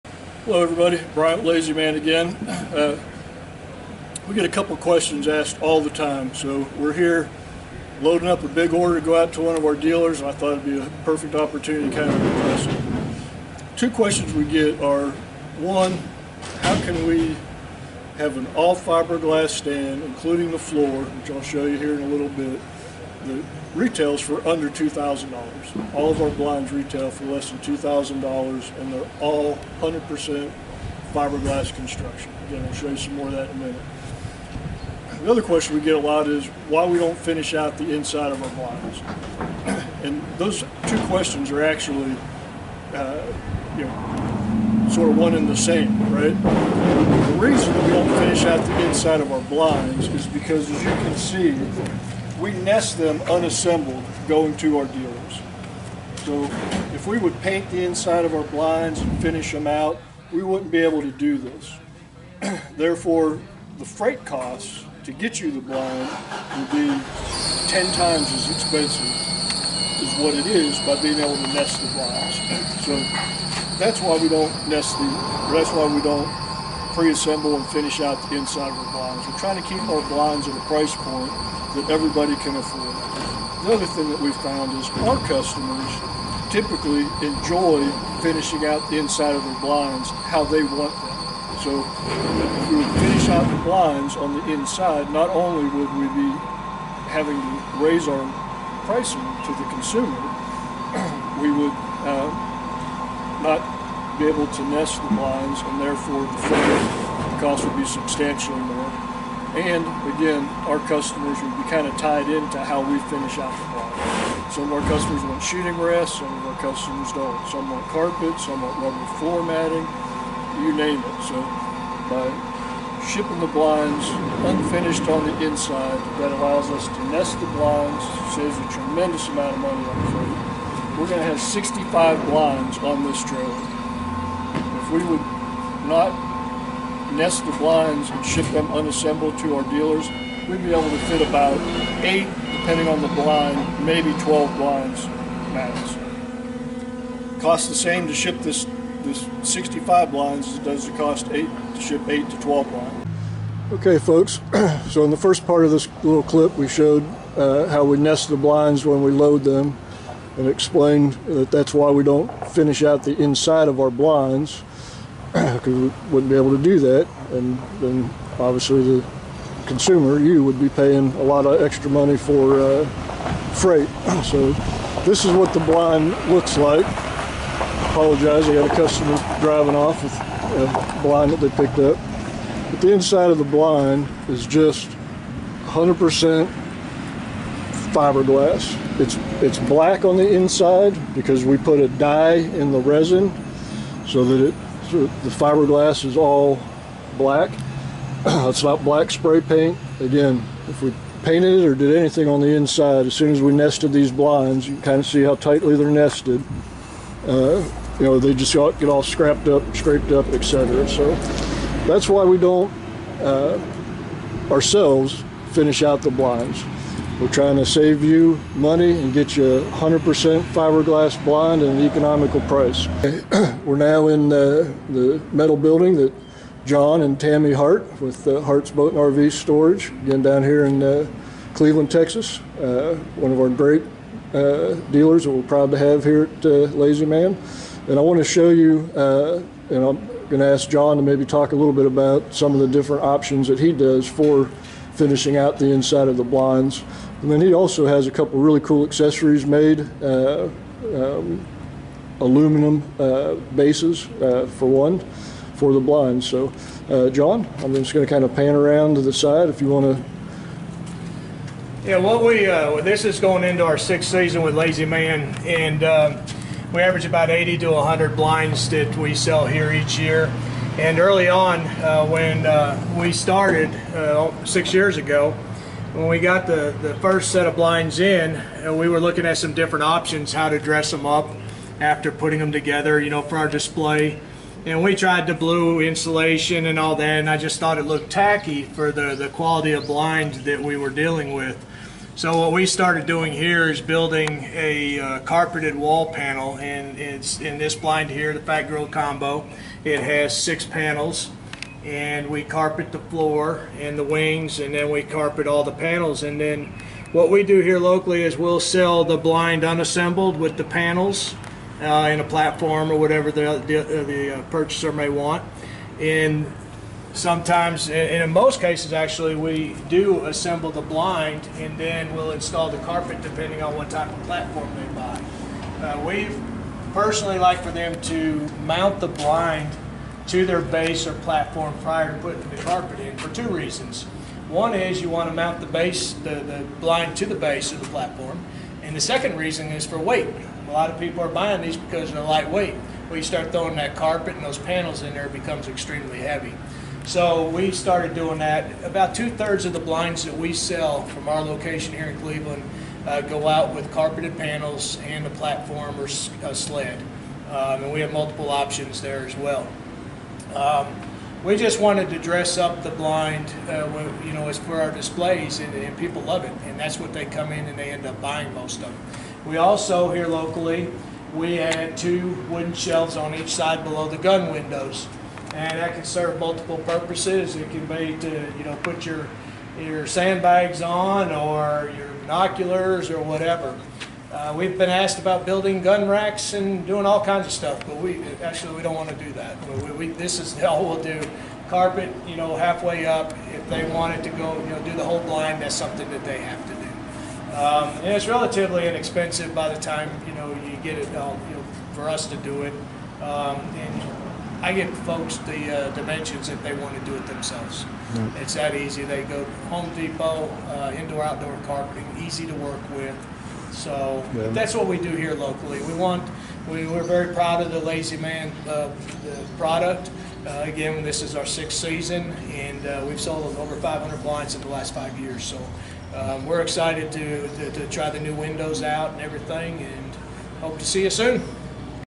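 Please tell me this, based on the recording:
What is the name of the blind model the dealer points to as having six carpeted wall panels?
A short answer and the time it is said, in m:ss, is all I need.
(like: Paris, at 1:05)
Fat Girl Combo, at 4:58.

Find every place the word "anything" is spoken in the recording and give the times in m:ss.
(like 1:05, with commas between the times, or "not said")
3:21.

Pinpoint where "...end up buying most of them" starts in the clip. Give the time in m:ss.
6:07.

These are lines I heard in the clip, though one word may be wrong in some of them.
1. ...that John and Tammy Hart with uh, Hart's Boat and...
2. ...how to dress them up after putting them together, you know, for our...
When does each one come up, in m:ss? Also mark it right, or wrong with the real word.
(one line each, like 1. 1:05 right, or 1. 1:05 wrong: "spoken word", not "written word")
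1. 3:45 right
2. 4:40 right.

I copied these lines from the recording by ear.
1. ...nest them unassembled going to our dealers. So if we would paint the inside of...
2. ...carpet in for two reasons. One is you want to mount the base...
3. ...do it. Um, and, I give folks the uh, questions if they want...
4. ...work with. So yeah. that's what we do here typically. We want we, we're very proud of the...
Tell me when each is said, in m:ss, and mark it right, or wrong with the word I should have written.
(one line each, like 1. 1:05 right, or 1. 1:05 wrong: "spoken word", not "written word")
1. 0:52 right
2. 5:32 right
3. 6:42 wrong: "dimensions", not "questions"
4. 6:52 wrong: "locally", not "typically".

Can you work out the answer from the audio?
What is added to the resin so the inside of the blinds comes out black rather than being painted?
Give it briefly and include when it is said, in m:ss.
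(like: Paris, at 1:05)
a dye, at 3:11.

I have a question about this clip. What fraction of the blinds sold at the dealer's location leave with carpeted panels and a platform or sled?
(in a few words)
two thirds.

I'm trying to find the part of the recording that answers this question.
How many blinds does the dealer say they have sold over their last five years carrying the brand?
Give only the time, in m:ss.
7:03.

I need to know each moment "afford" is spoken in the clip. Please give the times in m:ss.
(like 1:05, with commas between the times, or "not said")
1:22.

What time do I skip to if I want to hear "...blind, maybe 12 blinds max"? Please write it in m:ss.
2:23.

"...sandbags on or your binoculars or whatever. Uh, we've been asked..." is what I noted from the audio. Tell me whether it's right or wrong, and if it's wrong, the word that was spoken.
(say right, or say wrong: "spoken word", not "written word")
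right.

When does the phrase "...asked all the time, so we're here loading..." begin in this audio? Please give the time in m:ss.
0:05.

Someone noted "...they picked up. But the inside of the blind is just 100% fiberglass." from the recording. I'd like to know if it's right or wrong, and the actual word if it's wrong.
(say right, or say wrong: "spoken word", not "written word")
right.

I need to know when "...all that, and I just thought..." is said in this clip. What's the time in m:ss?
4:46.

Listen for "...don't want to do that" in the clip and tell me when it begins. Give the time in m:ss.
6:28.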